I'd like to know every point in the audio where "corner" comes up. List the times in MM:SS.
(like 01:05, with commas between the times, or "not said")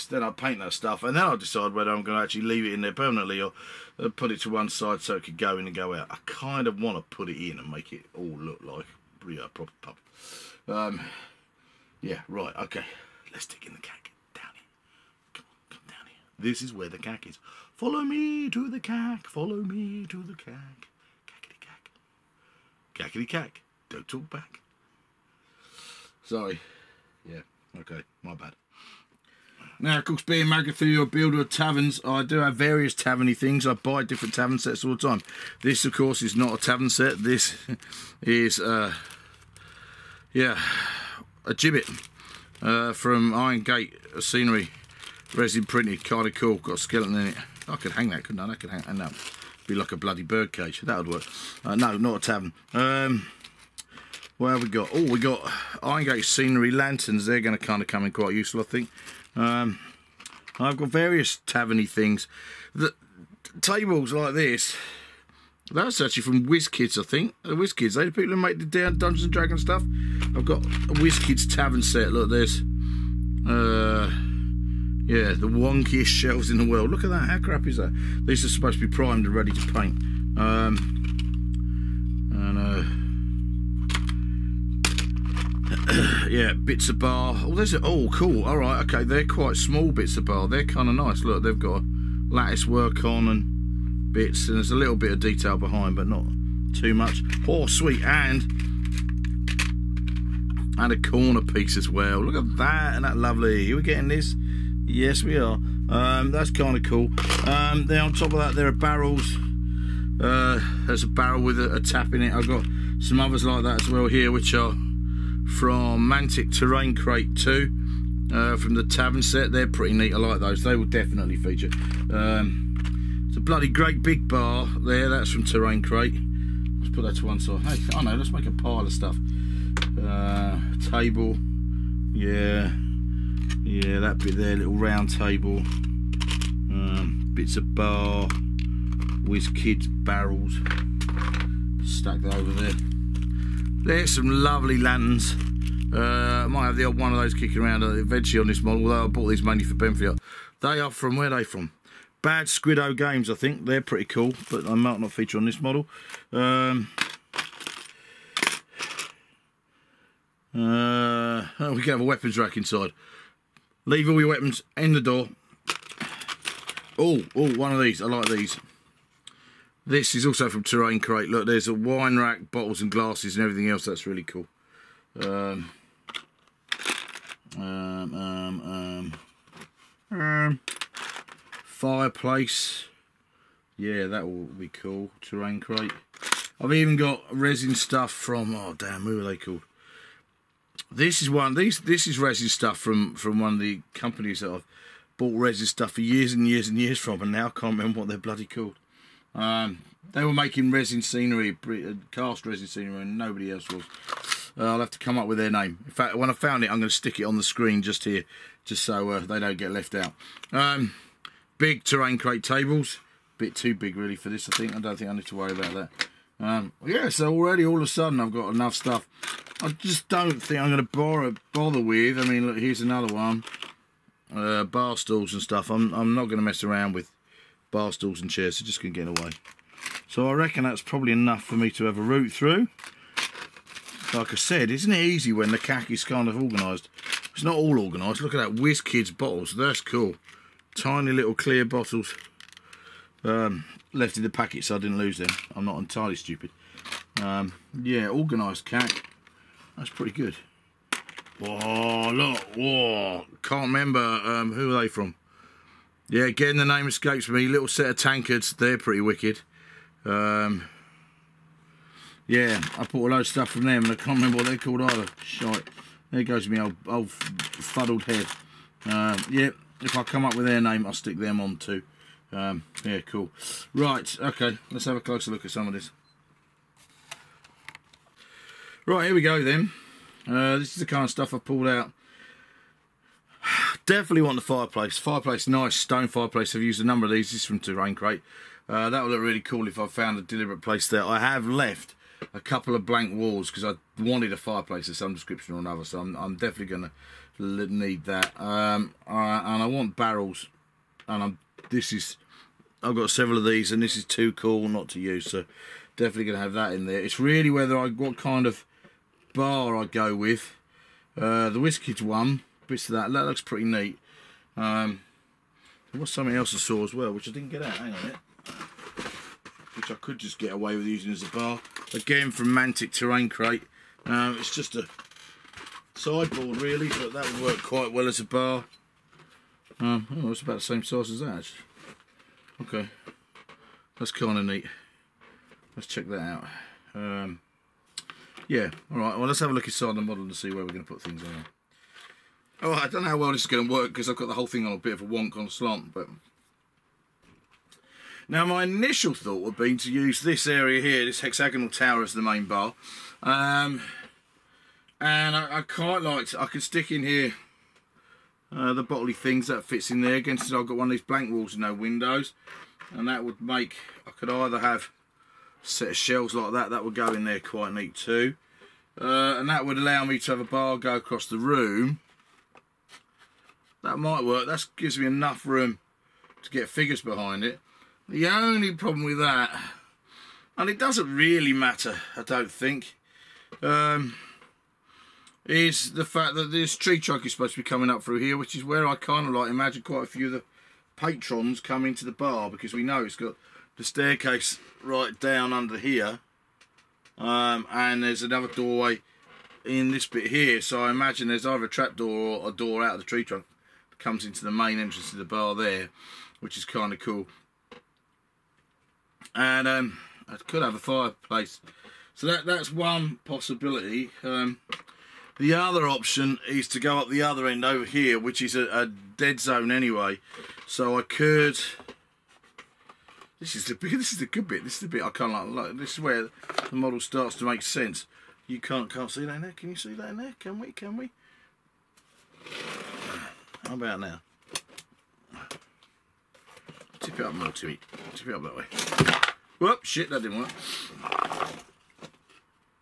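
01:40.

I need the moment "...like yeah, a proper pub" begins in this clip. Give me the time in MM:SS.
00:08.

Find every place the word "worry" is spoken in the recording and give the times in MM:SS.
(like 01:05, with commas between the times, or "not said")
03:35.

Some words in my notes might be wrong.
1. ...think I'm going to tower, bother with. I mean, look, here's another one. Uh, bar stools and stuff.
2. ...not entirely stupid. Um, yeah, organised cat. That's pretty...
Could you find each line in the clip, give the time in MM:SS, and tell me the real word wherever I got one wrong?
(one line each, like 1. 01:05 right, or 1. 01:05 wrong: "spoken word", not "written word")
1. 03:40 wrong: "bother", not "tower"
2. 04:05 right.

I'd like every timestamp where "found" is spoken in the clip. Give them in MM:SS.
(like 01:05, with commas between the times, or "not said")
03:26, 04:49.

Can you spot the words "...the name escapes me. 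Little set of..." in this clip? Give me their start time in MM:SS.
04:16.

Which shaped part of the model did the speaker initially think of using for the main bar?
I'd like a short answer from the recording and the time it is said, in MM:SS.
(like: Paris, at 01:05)
hexagonal tower, at 05:51.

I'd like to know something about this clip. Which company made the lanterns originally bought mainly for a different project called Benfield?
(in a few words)
Bad Squiddo Games.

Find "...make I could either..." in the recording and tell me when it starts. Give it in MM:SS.
06:03.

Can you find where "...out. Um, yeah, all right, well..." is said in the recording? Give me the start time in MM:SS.
05:36.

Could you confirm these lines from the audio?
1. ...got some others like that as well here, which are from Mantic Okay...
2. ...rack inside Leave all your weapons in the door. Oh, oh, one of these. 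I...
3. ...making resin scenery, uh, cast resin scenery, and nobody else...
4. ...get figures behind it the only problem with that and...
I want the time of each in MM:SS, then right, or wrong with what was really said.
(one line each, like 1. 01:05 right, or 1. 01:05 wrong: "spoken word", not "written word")
1. 01:52 wrong: "Terrain", not "Okay"
2. 02:42 right
3. 03:20 right
4. 06:16 right.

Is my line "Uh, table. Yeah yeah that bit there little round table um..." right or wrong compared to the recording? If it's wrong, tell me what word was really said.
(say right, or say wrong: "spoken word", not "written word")
right.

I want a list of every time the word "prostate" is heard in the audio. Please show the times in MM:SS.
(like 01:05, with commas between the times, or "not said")
not said.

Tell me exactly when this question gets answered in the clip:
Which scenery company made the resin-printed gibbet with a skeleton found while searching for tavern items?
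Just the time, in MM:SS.
00:43.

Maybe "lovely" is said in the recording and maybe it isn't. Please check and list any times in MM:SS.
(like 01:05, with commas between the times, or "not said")
01:43, 02:24.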